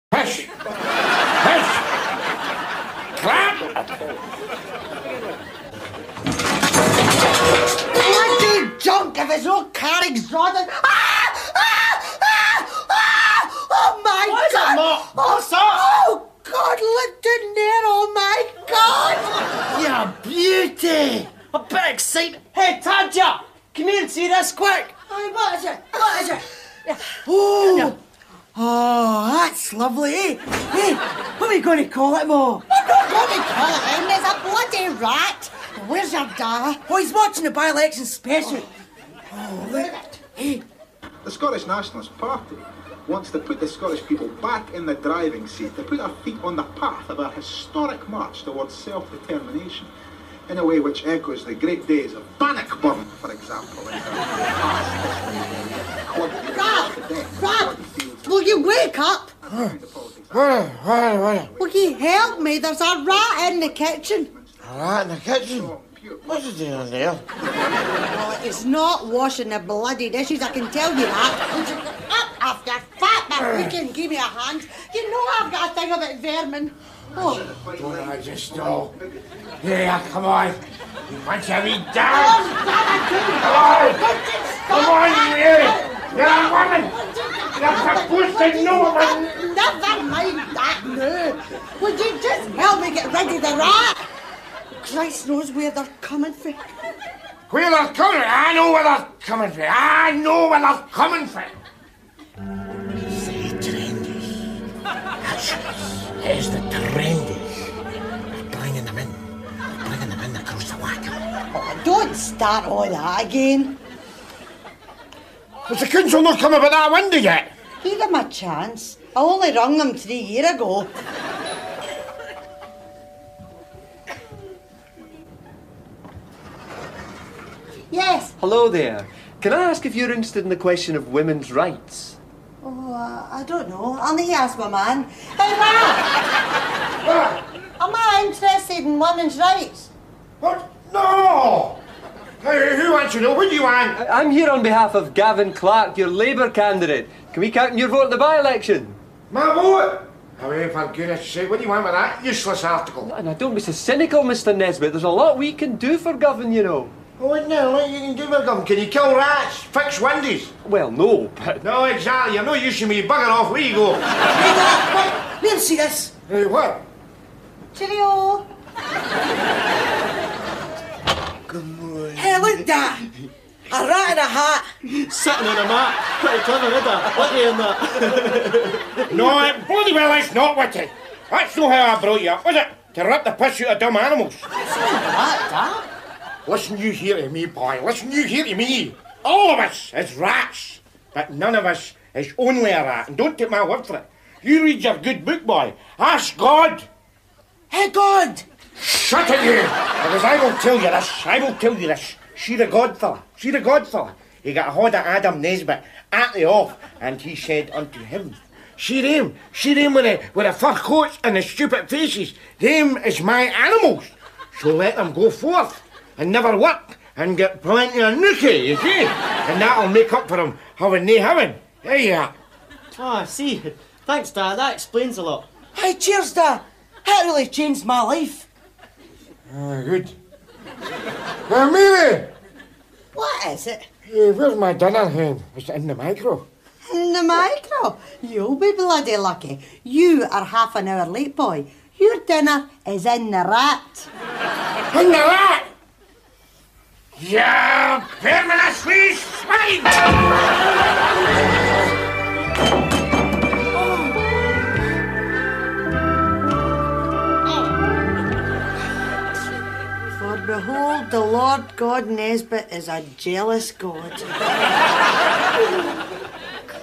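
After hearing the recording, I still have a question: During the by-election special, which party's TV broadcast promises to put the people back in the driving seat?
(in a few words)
Scottish Nationalist Party.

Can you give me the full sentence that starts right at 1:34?
Christ knows where they're coming from.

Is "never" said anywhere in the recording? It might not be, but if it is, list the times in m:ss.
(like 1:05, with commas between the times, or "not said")
1:29, 3:36.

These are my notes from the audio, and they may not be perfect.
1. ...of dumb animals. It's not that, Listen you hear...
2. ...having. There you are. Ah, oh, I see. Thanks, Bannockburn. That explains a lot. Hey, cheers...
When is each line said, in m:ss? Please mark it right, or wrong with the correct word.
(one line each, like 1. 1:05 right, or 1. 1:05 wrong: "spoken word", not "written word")
1. 3:03 right
2. 3:41 wrong: "Dad", not "Bannockburn".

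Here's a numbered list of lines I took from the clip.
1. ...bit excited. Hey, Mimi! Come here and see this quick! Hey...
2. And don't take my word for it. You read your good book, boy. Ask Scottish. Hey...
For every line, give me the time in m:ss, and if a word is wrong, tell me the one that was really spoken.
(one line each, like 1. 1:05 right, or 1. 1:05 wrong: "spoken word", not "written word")
1. 0:21 wrong: "Tadja", not "Mimi"
2. 3:13 wrong: "God", not "Scottish".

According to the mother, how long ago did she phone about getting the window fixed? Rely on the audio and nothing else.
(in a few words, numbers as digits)
3 years ago.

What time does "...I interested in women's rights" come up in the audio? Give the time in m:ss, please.
2:17.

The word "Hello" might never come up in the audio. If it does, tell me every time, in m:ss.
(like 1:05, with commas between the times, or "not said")
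2:08.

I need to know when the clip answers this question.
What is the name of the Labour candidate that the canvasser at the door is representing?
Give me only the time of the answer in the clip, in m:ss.
2:25.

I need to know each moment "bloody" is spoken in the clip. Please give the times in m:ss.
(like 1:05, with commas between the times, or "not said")
0:34, 1:09, 2:59, 3:58.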